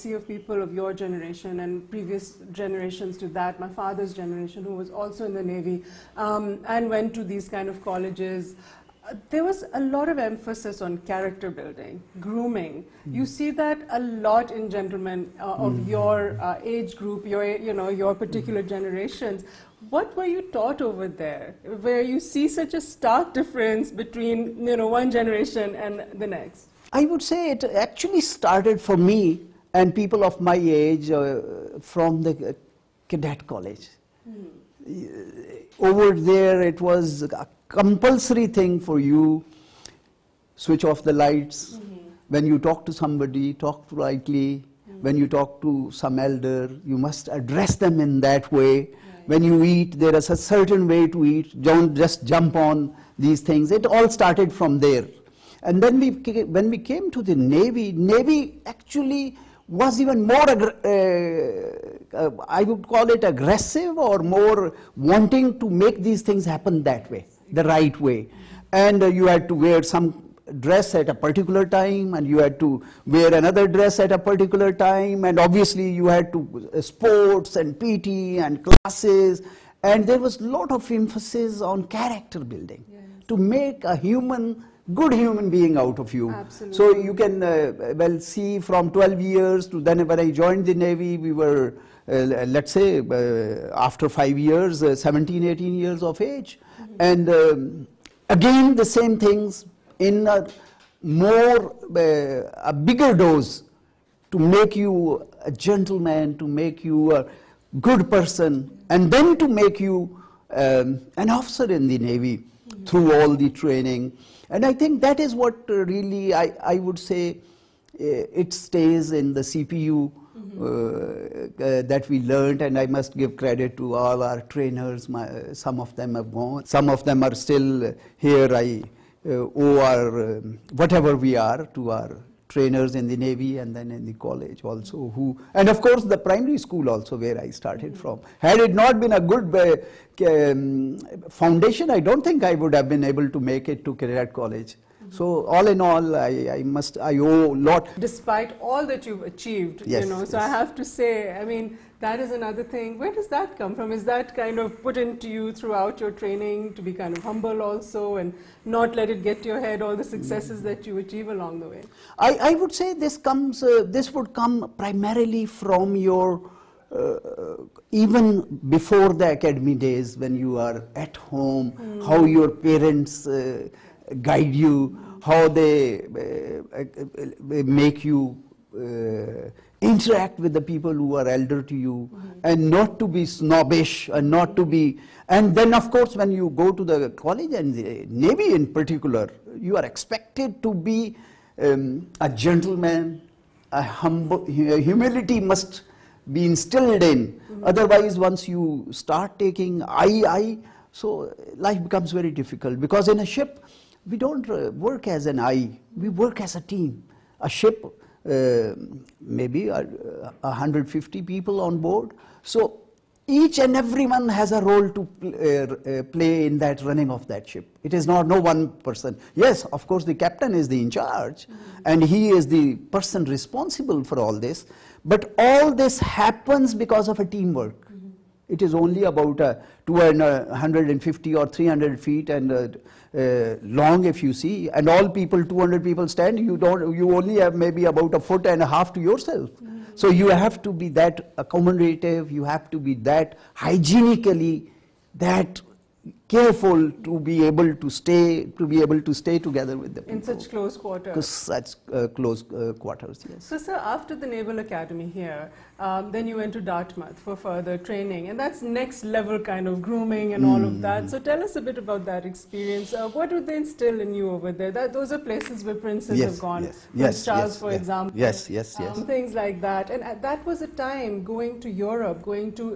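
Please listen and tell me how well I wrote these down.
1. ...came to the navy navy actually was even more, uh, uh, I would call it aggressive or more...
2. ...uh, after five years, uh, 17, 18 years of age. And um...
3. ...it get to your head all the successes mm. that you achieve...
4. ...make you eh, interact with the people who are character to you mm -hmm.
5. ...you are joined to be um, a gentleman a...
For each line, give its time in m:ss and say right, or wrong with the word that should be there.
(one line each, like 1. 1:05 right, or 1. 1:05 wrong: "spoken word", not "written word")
1. 0:56 right
2. 1:32 right
3. 2:39 right
4. 2:57 wrong: "elder", not "character"
5. 3:09 wrong: "expected", not "joined".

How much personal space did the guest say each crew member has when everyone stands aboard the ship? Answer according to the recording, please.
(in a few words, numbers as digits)
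a foot and a half.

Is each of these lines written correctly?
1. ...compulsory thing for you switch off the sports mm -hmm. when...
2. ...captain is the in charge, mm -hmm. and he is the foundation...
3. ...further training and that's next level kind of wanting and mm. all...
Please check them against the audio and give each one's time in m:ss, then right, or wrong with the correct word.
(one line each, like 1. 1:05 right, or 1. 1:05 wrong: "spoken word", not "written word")
1. 0:37 wrong: "lights", not "sports"
2. 3:40 wrong: "person", not "foundation"
3. 4:17 wrong: "grooming", not "wanting".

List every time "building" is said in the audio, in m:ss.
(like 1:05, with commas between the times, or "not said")
0:11, 1:22.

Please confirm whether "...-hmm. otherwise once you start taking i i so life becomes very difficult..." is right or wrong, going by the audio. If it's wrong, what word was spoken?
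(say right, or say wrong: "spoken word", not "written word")
right.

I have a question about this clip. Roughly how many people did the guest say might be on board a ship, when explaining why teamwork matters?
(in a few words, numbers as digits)
150.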